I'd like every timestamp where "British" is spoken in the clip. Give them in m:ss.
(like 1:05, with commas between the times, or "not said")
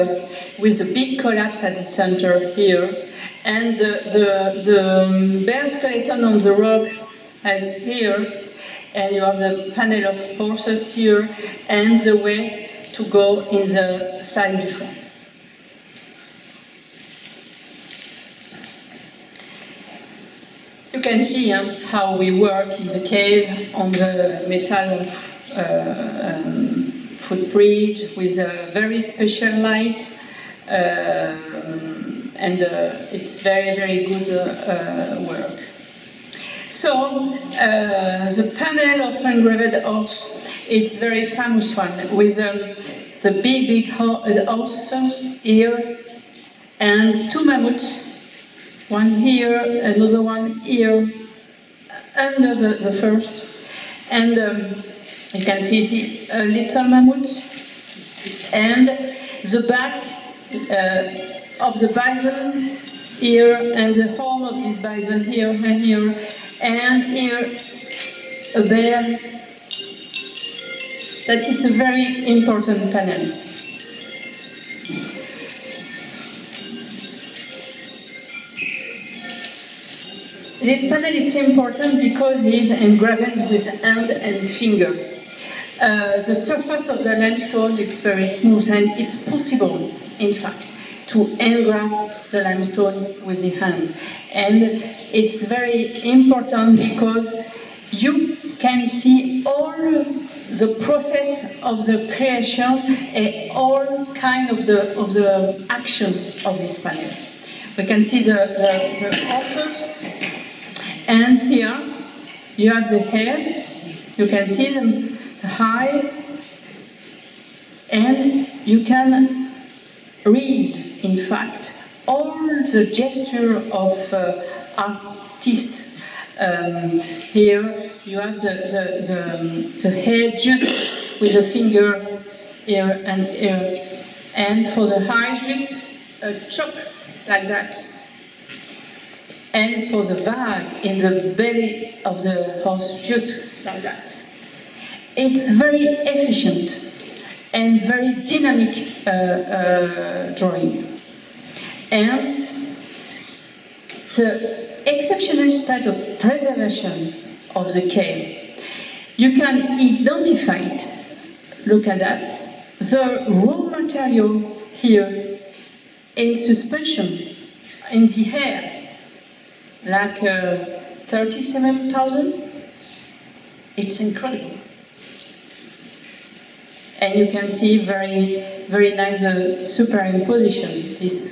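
not said.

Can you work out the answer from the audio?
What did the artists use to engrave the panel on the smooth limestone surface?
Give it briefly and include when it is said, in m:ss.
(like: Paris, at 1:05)
Hand and finger, at 1:23.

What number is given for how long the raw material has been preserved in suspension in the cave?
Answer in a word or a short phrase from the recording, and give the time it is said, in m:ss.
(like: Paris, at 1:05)
37,000, at 2:51.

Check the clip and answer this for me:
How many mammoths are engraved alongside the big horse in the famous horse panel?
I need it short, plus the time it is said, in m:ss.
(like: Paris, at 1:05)
2, at 0:47.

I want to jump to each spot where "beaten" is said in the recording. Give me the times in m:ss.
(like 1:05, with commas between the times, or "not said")
not said.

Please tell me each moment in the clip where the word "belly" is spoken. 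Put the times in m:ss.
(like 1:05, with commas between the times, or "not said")
2:21.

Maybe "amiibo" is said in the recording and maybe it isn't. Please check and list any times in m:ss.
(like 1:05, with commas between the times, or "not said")
not said.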